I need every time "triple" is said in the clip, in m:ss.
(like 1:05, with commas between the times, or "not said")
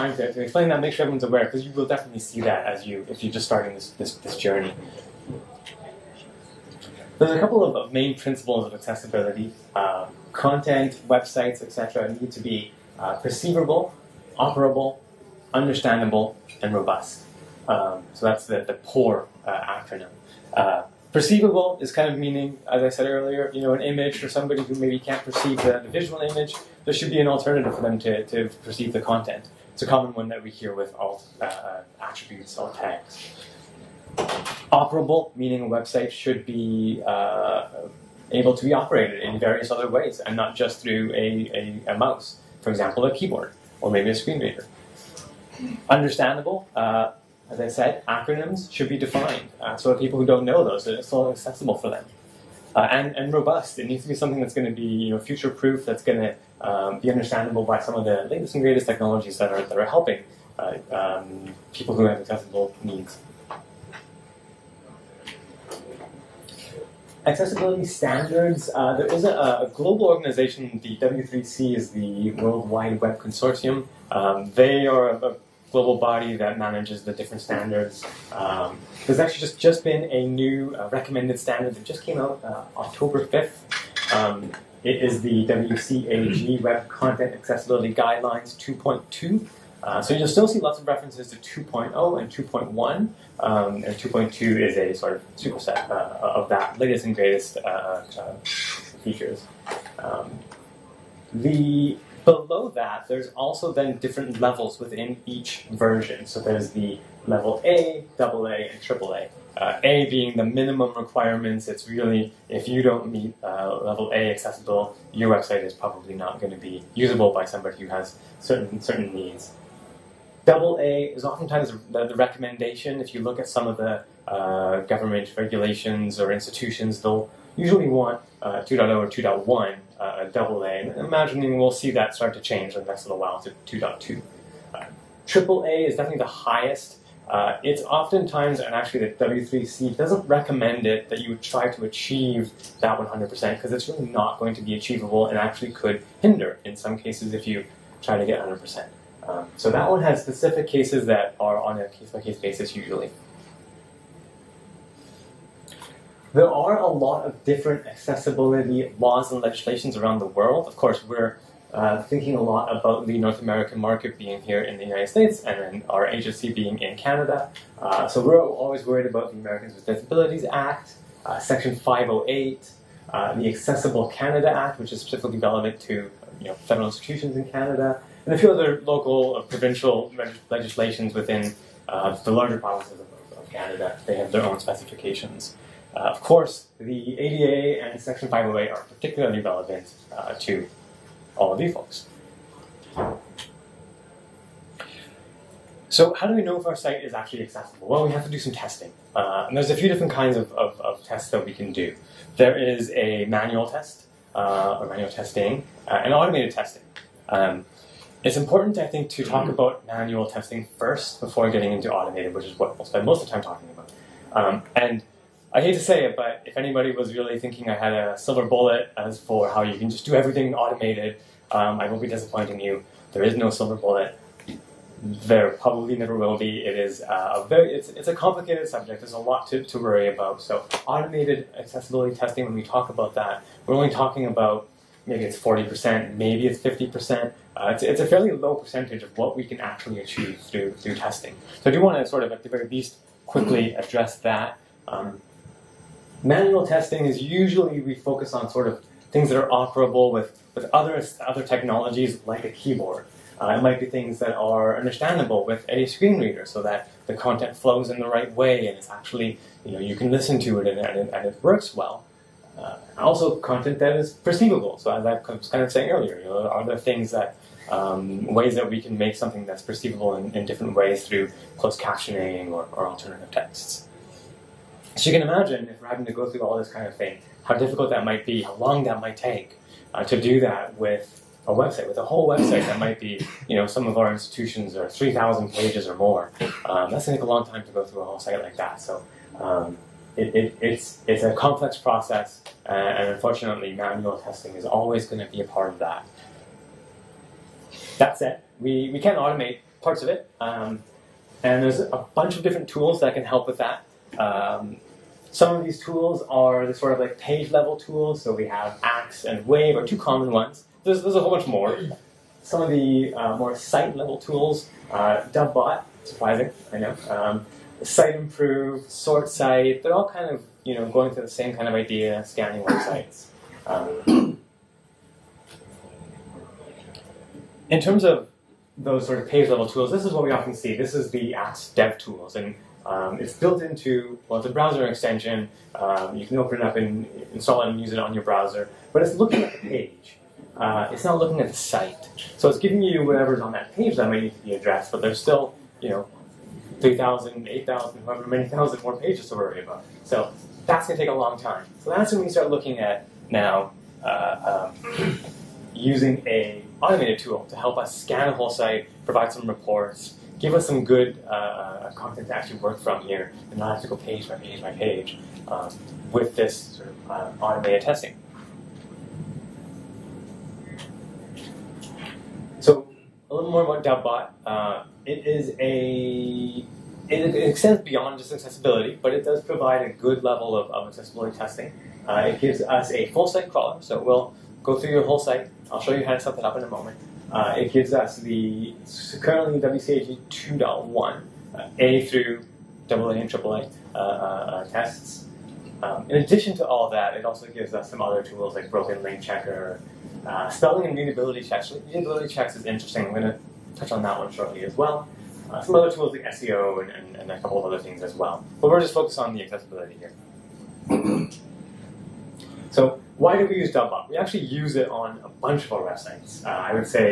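1:48, 2:15.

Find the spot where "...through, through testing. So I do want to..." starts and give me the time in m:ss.
4:00.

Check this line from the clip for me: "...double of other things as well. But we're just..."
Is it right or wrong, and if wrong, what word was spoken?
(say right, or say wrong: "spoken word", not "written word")
wrong: "couple", not "double".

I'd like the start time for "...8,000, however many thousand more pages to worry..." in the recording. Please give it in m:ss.
5:47.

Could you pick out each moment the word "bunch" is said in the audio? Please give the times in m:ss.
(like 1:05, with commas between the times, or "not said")
5:02, 5:11, 6:55.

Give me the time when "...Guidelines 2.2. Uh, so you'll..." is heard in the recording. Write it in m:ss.
1:27.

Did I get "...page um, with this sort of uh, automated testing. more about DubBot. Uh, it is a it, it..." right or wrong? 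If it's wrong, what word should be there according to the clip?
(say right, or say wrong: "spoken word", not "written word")
right.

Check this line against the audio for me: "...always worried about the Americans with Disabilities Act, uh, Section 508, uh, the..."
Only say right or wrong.
right.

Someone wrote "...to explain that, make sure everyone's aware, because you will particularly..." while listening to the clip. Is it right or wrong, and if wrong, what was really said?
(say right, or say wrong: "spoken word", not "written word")
wrong: "definitely", not "particularly".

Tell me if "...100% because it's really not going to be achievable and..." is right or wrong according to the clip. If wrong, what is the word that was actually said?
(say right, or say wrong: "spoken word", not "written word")
right.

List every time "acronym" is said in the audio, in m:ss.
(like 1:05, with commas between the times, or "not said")
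0:19, 0:48.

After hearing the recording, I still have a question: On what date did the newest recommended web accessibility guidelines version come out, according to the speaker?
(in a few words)
October 5th.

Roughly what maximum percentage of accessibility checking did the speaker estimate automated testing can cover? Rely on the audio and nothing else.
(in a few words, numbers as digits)
50%.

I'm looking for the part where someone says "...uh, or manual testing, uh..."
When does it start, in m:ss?
3:24.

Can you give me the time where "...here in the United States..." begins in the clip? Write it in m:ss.
2:44.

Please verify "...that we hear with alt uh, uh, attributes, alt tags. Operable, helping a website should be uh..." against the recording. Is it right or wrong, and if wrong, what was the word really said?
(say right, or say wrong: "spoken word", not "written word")
wrong: "meaning", not "helping".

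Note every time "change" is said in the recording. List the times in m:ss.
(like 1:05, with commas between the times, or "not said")
2:12.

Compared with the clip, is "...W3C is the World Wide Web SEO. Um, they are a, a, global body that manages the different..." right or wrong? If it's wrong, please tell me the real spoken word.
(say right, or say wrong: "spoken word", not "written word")
wrong: "Consortium", not "SEO".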